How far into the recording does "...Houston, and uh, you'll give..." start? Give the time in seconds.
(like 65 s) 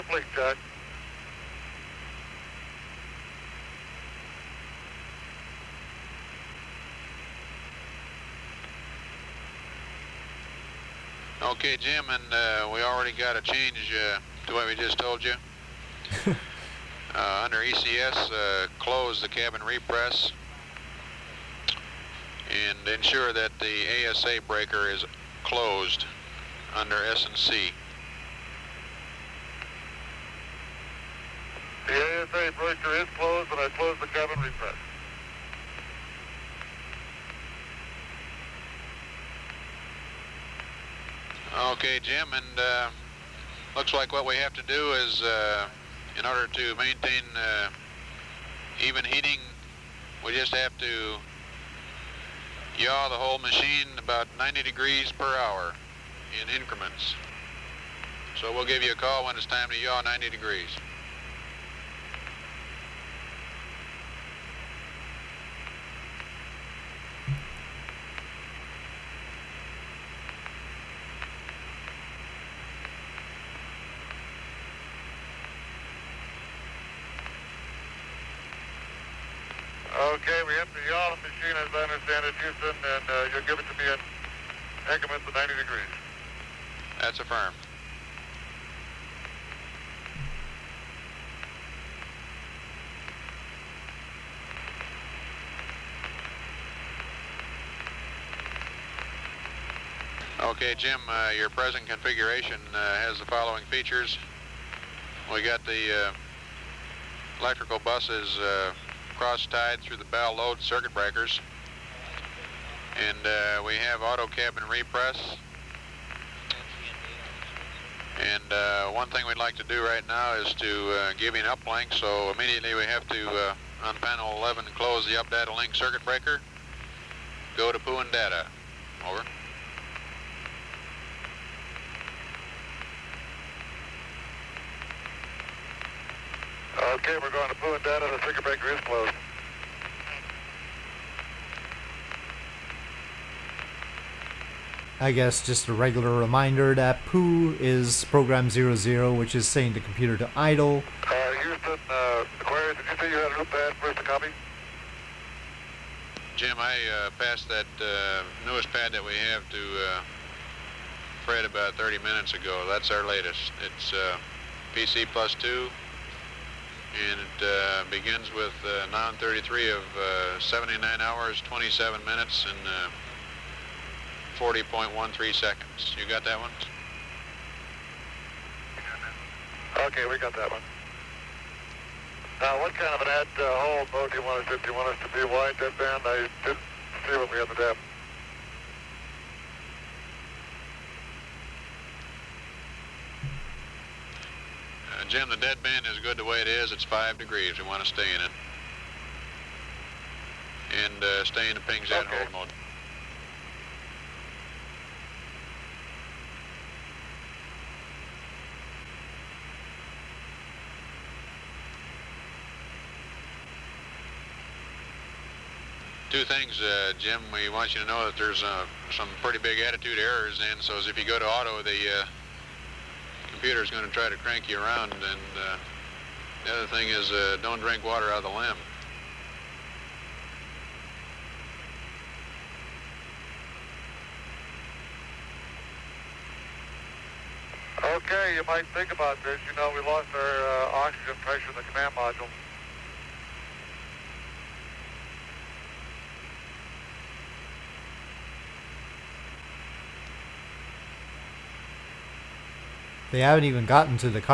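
82 s.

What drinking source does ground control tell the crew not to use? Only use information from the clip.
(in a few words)
Water out of the LEM.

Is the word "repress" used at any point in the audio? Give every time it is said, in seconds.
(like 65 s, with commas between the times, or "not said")
19 s, 34 s, 114 s.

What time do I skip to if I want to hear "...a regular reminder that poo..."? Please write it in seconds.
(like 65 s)
145 s.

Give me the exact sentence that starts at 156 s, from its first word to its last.
Jim, I uh, passed that uh, newest pad that we have to uh, Fred about 30 minutes ago.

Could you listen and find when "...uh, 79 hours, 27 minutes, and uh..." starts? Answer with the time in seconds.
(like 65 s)
169 s.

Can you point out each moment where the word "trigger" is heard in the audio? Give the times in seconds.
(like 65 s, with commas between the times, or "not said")
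138 s.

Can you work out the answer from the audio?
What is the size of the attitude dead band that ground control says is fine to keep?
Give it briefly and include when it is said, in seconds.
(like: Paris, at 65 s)
5 degrees, at 196 s.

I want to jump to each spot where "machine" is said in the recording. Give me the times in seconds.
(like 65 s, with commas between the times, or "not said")
53 s, 81 s.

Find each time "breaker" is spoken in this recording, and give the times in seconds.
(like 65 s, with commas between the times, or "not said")
24 s, 32 s, 110 s, 126 s.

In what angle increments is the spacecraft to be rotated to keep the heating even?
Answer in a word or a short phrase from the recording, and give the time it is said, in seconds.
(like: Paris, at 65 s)
90 degrees, at 54 s.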